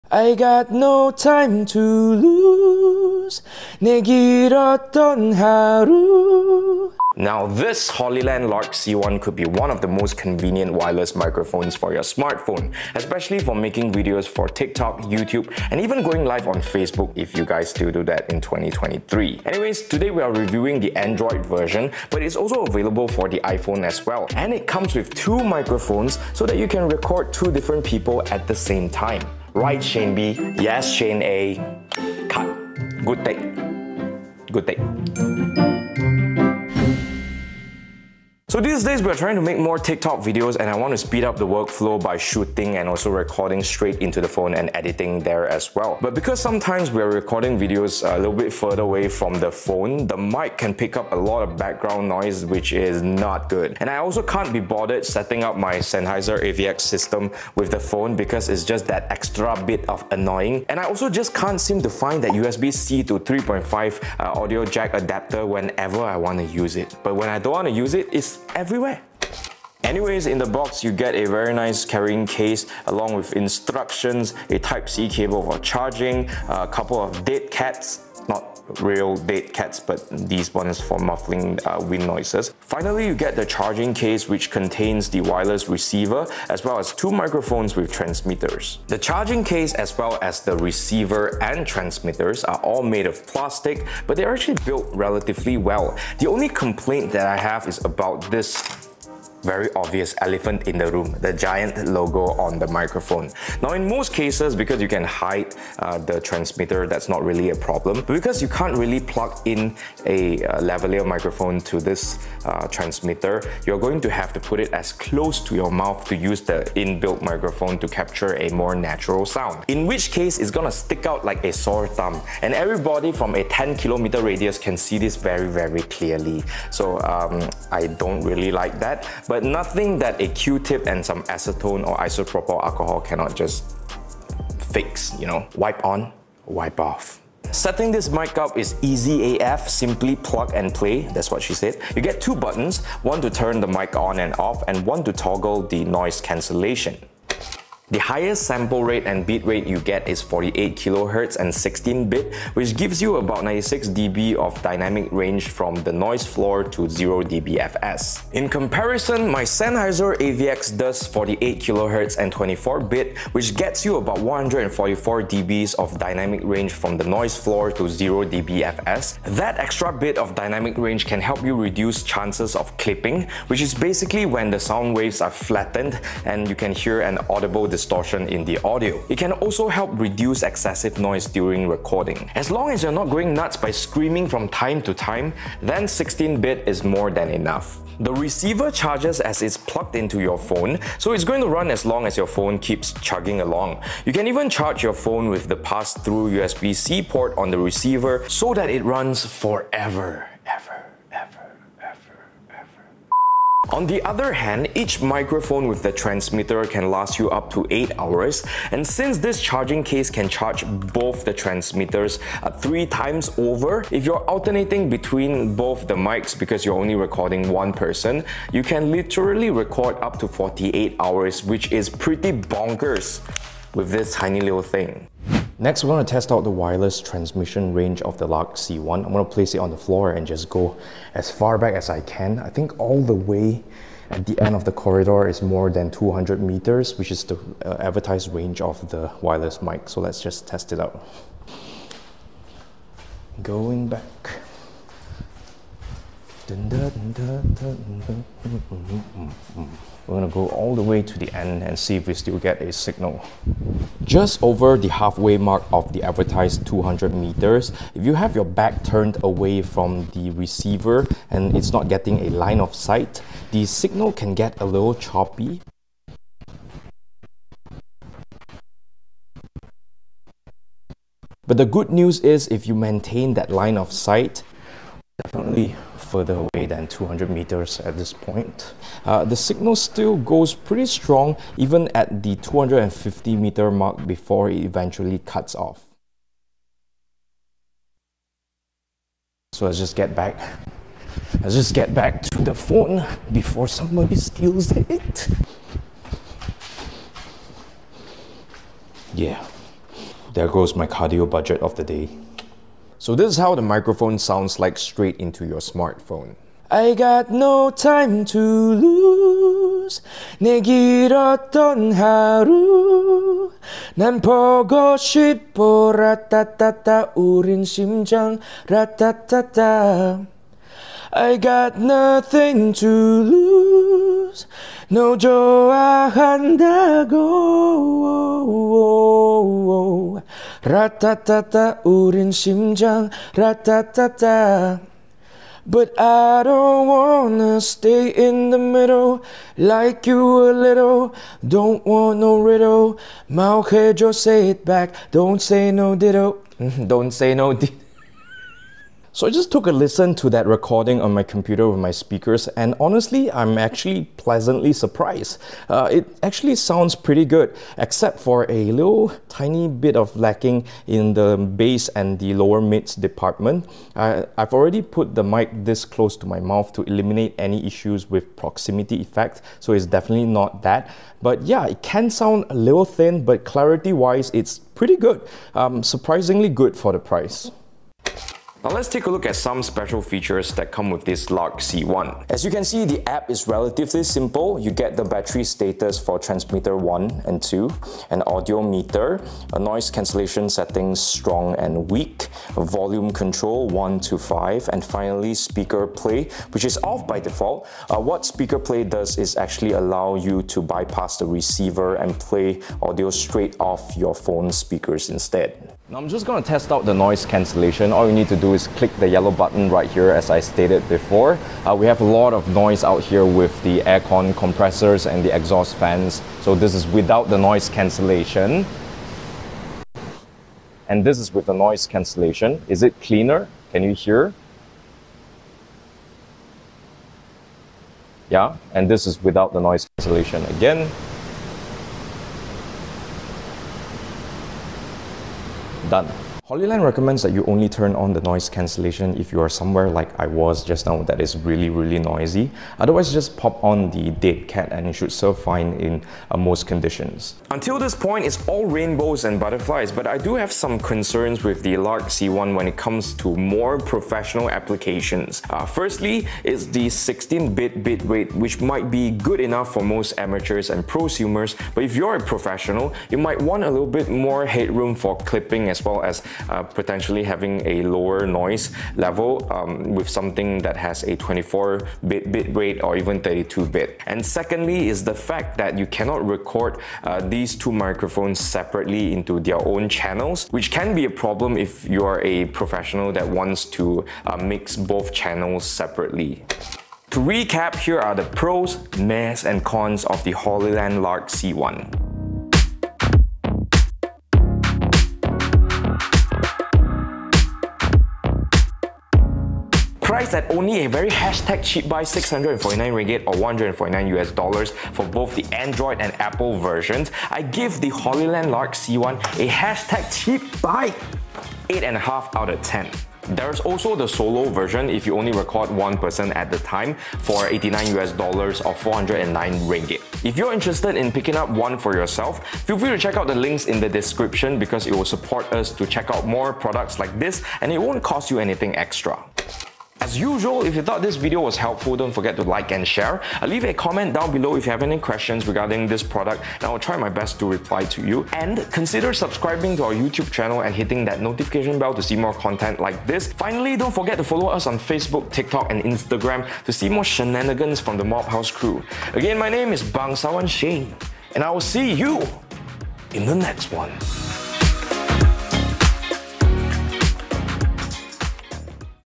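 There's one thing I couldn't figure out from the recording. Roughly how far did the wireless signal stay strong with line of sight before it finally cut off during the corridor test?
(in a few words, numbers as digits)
250 meters.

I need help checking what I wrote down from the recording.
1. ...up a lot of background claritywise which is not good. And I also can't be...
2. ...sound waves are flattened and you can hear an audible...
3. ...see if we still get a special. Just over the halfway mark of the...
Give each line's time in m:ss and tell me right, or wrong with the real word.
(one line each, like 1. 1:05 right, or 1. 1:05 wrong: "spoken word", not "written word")
1. 0:50 wrong: "noise", not "claritywise"
2. 2:54 right
3. 4:11 wrong: "signal", not "special".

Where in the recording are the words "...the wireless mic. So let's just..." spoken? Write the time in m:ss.
3:58.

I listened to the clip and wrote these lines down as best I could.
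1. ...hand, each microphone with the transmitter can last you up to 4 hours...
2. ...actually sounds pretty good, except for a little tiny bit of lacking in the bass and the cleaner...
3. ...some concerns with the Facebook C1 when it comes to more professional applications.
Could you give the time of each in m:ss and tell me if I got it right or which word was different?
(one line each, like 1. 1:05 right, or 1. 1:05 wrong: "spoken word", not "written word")
1. 3:24 wrong: "8", not "4"
2. 5:56 wrong: "lower", not "cleaner"
3. 7:30 wrong: "Lark", not "Facebook".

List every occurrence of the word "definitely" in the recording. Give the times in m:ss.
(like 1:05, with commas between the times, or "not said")
4:35, 6:09.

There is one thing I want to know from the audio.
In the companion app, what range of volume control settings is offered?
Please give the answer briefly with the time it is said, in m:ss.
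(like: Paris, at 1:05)
1 to 5, at 6:33.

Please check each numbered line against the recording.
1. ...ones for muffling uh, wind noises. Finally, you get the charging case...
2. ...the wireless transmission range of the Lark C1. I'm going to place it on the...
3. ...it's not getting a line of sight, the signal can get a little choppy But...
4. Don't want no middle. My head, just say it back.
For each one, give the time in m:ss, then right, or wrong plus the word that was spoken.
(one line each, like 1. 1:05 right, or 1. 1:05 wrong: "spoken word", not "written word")
1. 1:20 right
2. 3:46 right
3. 4:21 right
4. 5:41 wrong: "riddle", not "middle".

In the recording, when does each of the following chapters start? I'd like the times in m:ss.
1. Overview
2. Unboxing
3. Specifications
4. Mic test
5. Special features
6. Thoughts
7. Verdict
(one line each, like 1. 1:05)
1. 0:37
2. 1:09
3. 2:26
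4. 3:44
5. 6:16
6. 7:25
7. 8:05.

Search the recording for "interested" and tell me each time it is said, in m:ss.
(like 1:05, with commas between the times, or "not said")
8:40.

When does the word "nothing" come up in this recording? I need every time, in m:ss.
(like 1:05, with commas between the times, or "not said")
2:09, 5:21.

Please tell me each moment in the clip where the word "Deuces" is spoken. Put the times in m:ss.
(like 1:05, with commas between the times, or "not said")
not said.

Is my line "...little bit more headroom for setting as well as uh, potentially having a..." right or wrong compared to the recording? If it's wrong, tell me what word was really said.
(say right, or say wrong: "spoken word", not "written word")
wrong: "clipping", not "setting".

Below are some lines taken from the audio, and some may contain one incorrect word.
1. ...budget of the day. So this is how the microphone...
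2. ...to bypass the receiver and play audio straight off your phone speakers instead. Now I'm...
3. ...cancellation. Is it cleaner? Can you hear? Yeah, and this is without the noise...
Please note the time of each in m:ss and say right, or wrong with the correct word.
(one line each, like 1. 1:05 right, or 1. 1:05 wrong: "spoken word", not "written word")
1. 5:01 right
2. 6:40 right
3. 7:01 right.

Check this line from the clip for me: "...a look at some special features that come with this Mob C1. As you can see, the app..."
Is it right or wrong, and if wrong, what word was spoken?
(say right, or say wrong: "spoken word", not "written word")
wrong: "Lark", not "Mob".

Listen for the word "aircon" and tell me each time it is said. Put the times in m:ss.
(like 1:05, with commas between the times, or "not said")
6:53.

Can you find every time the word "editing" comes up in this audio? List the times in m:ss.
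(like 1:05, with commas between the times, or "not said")
0:44.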